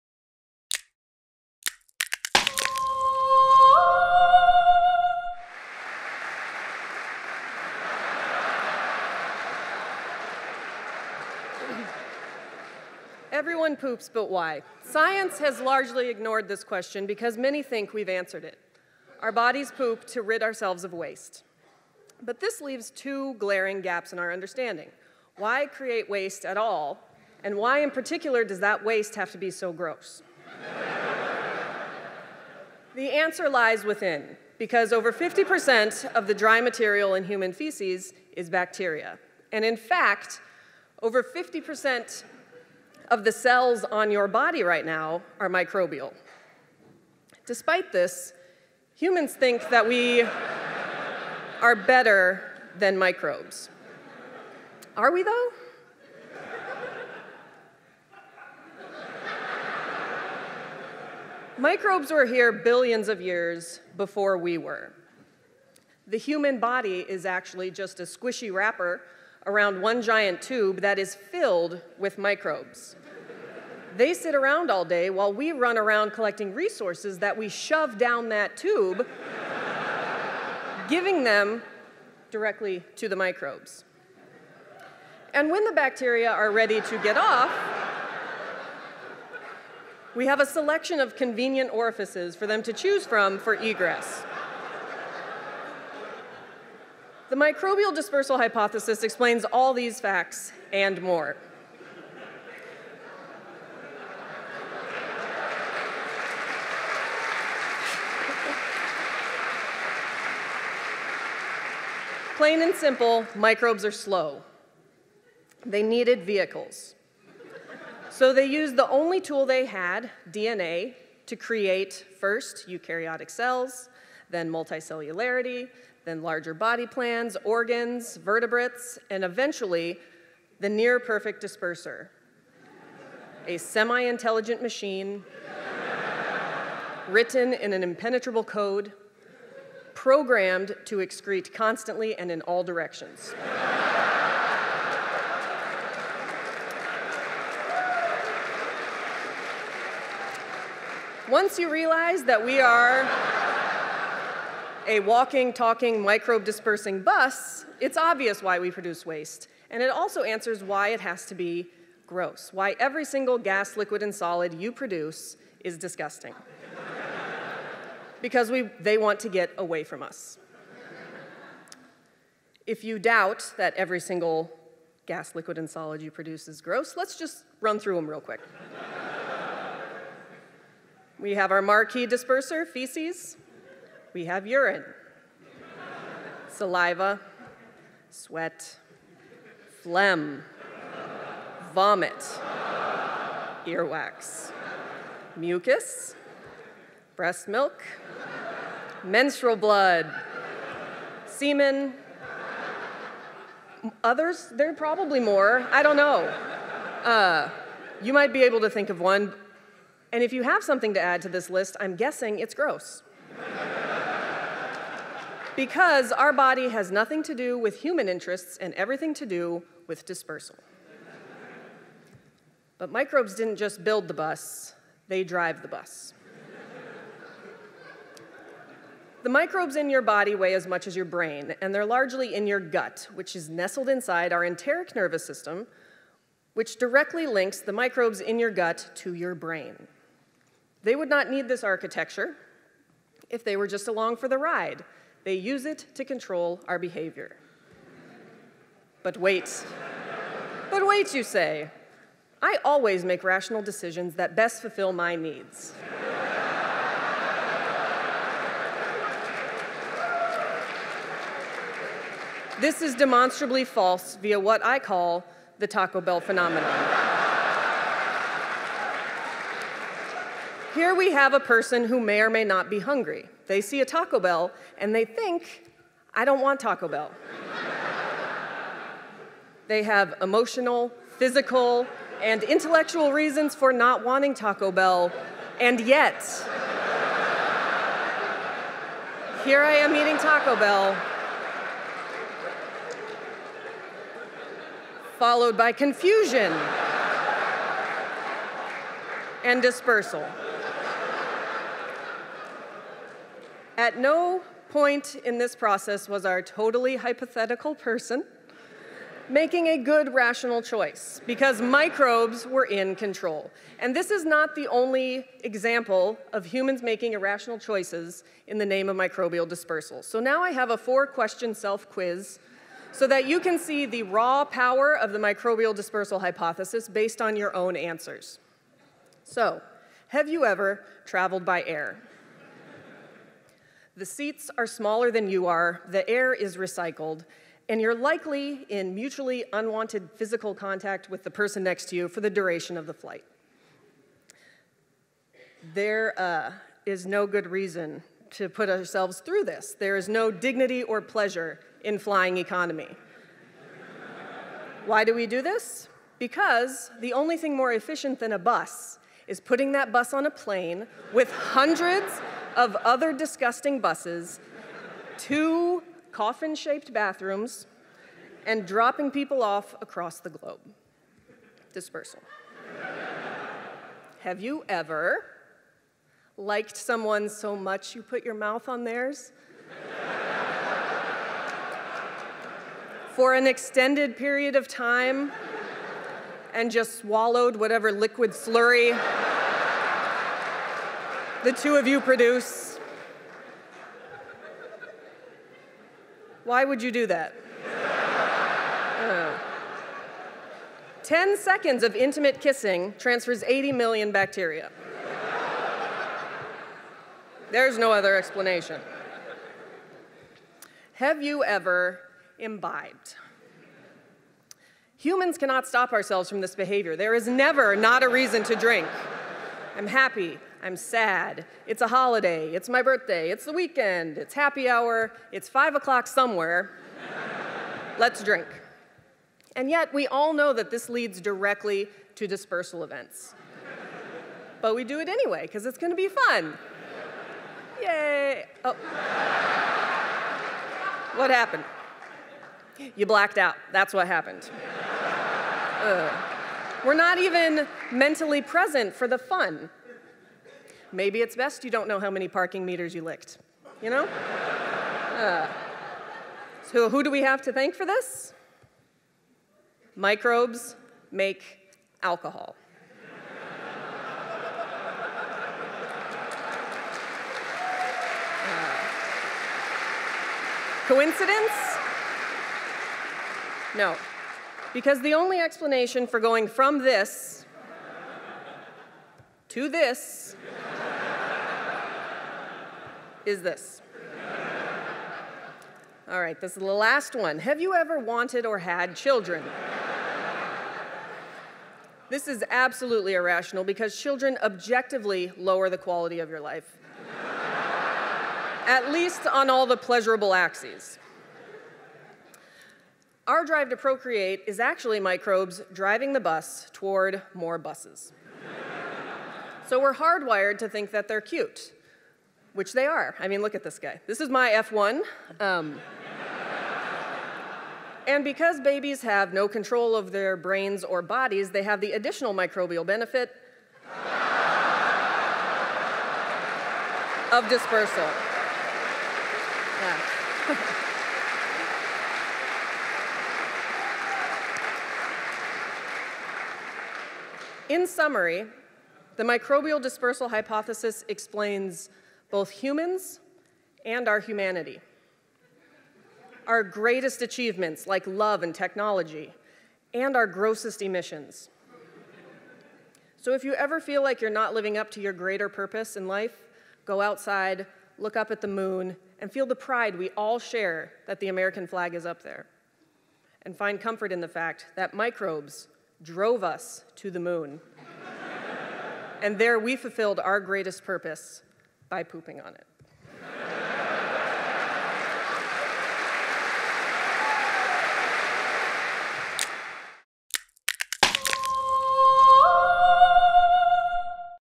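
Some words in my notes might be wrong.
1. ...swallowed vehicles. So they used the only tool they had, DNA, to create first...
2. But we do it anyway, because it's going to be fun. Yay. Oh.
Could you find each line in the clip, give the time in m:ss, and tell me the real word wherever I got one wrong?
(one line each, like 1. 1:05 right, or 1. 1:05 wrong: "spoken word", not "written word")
1. 1:55 wrong: "needed", not "swallowed"
2. 7:14 right.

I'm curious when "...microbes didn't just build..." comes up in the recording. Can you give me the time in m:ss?
3:42.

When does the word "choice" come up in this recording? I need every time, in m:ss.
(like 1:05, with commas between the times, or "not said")
5:10, 5:17.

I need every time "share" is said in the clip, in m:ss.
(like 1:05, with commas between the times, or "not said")
9:20.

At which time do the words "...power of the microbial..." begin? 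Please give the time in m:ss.
5:24.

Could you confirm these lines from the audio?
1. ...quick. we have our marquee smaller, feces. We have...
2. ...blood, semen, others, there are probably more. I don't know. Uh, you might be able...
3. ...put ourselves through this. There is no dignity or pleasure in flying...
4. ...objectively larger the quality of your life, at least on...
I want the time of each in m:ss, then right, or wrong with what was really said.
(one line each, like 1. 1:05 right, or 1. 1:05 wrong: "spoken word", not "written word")
1. 2:58 wrong: "disperser", not "smaller"
2. 3:19 right
3. 5:48 right
4. 8:14 wrong: "lower", not "larger".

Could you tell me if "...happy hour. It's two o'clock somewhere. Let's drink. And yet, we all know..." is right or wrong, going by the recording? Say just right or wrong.
wrong.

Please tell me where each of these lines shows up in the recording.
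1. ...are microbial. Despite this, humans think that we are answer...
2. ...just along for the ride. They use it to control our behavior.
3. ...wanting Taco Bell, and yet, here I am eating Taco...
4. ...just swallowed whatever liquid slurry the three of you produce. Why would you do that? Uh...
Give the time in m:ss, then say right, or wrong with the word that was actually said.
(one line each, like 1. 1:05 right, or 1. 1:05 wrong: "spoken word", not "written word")
1. 0:45 wrong: "better", not "answer"
2. 4:03 right
3. 4:44 right
4. 6:26 wrong: "two", not "three".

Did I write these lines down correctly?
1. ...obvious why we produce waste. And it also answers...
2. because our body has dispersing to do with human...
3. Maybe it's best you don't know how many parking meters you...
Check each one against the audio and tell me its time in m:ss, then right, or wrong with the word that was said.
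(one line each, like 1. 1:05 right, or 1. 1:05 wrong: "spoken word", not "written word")
1. 2:37 right
2. 3:35 wrong: "nothing", not "dispersing"
3. 7:30 right.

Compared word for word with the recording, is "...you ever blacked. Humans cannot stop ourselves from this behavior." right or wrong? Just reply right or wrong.
wrong.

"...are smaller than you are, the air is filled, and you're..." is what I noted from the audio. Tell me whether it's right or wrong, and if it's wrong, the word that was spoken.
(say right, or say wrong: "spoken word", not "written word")
wrong: "recycled", not "filled".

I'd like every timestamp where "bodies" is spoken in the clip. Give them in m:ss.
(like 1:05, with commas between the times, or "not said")
0:19, 8:41.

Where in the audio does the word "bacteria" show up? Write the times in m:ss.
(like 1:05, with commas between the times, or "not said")
0:38, 1:25, 6:44.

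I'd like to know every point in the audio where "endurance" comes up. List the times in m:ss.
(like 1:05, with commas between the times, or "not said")
not said.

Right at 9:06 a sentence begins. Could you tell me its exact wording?
Our greatest achievements, like love and technology, and our grossest emissions.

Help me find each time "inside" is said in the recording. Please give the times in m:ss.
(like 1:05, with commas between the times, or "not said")
3:53.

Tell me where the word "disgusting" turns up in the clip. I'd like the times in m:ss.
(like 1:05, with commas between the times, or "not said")
2:45, 6:03.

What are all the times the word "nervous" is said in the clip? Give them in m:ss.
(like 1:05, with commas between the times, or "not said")
3:54.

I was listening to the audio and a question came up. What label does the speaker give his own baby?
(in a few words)
F1.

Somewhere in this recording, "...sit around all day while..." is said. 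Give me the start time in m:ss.
1:14.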